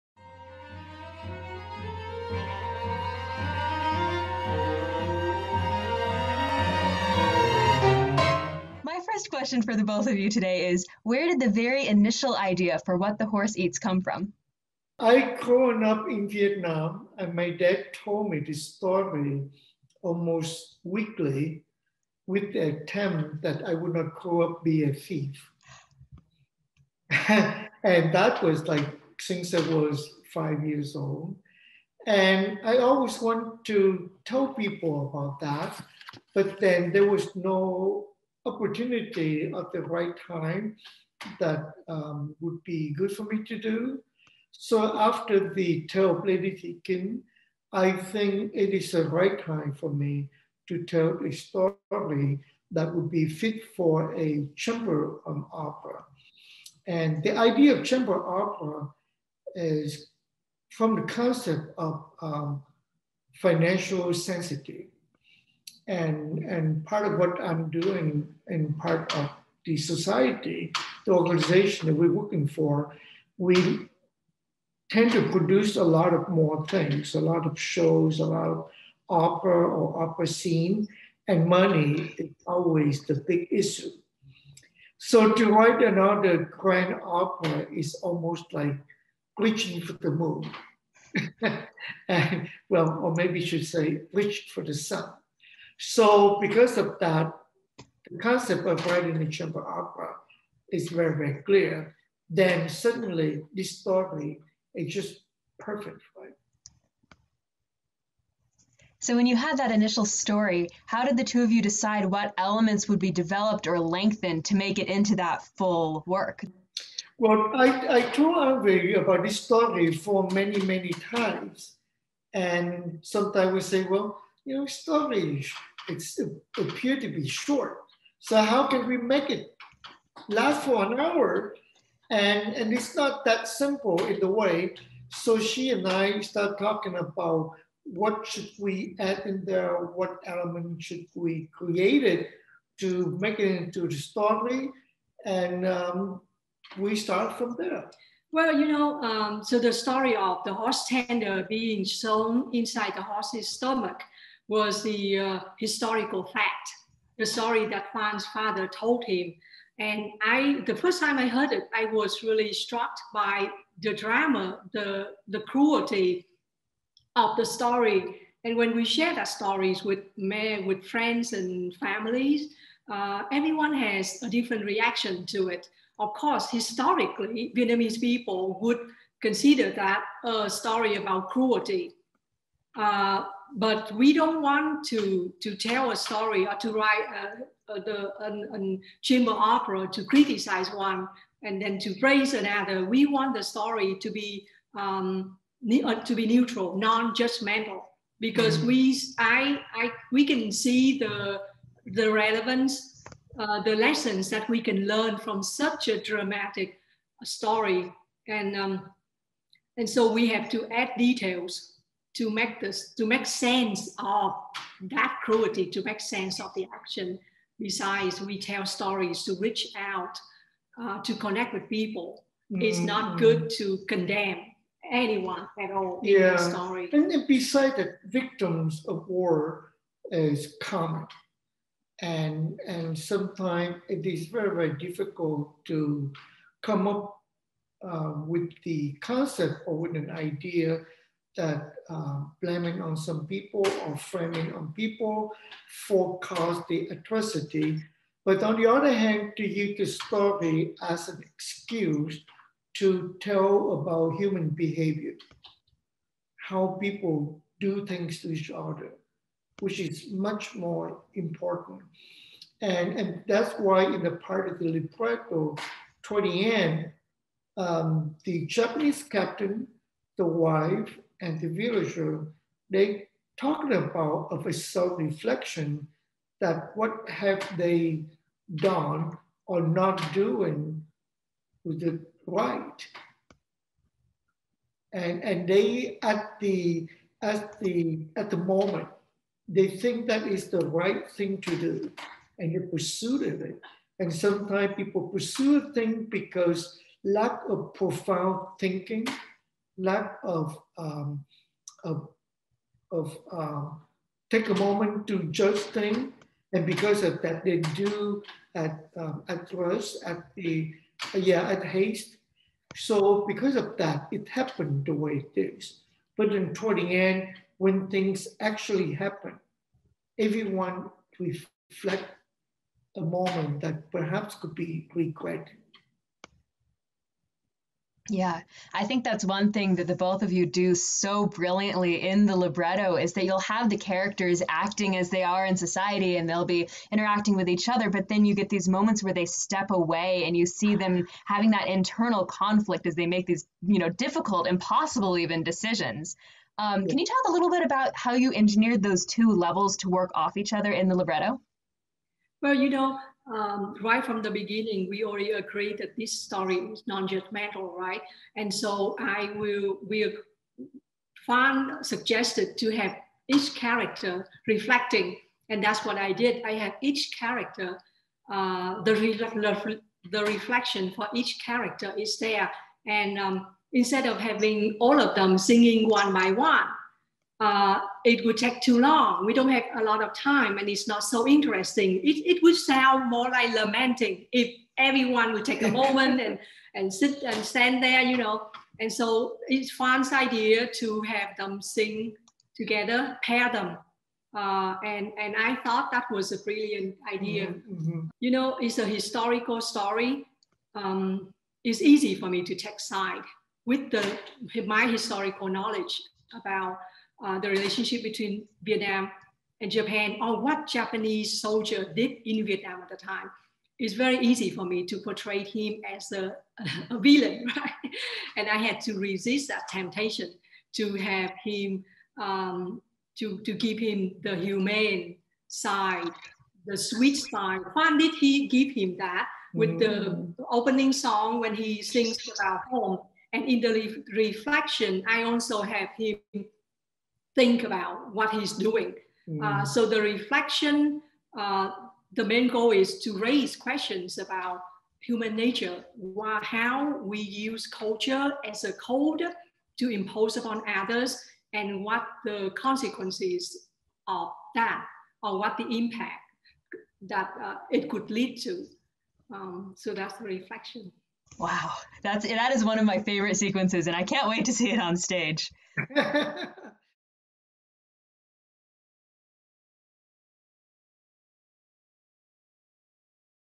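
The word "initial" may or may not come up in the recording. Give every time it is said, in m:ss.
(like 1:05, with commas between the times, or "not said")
0:11, 1:49.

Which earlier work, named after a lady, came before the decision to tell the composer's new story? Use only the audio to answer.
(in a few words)
Lady Thi Kinh.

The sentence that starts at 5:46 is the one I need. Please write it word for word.
Um, can you talk a little bit about how you engineered those two levels to work off each other in the libretto?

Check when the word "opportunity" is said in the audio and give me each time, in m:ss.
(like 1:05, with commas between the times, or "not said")
0:38.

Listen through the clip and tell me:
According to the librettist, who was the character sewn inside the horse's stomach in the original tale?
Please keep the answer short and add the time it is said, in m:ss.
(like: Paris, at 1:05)
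the horse tender, at 2:30.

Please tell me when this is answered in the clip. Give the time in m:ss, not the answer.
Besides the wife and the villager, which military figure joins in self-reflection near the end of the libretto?
4:28.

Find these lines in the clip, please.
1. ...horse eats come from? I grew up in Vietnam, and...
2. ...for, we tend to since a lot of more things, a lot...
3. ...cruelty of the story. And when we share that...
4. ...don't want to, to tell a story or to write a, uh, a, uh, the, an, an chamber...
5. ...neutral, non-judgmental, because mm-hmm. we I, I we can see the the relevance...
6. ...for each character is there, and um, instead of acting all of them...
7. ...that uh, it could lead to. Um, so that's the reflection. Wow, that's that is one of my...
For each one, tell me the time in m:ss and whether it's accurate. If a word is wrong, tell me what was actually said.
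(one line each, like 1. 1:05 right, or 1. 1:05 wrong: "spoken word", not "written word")
1. 0:13 right
2. 1:12 wrong: "produce", not "since"
3. 2:45 right
4. 3:04 right
5. 3:16 right
6. 6:10 wrong: "having", not "acting"
7. 7:37 right.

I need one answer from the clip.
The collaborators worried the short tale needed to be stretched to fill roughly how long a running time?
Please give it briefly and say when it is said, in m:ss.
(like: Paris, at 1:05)
an hour, at 2:10.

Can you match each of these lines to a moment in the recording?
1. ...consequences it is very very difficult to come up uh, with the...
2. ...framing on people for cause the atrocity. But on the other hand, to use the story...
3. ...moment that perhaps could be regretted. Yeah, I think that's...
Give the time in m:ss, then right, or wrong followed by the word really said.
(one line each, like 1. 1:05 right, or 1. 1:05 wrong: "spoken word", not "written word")
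1. 3:52 wrong: "sometimes", not "consequences"
2. 4:03 right
3. 5:23 right.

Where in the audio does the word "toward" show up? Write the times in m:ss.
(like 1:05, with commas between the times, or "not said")
4:26, 5:16.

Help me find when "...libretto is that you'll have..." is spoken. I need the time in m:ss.
5:32.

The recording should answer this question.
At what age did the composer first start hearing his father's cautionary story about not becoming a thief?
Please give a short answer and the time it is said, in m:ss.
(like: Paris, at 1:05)
5, at 0:30.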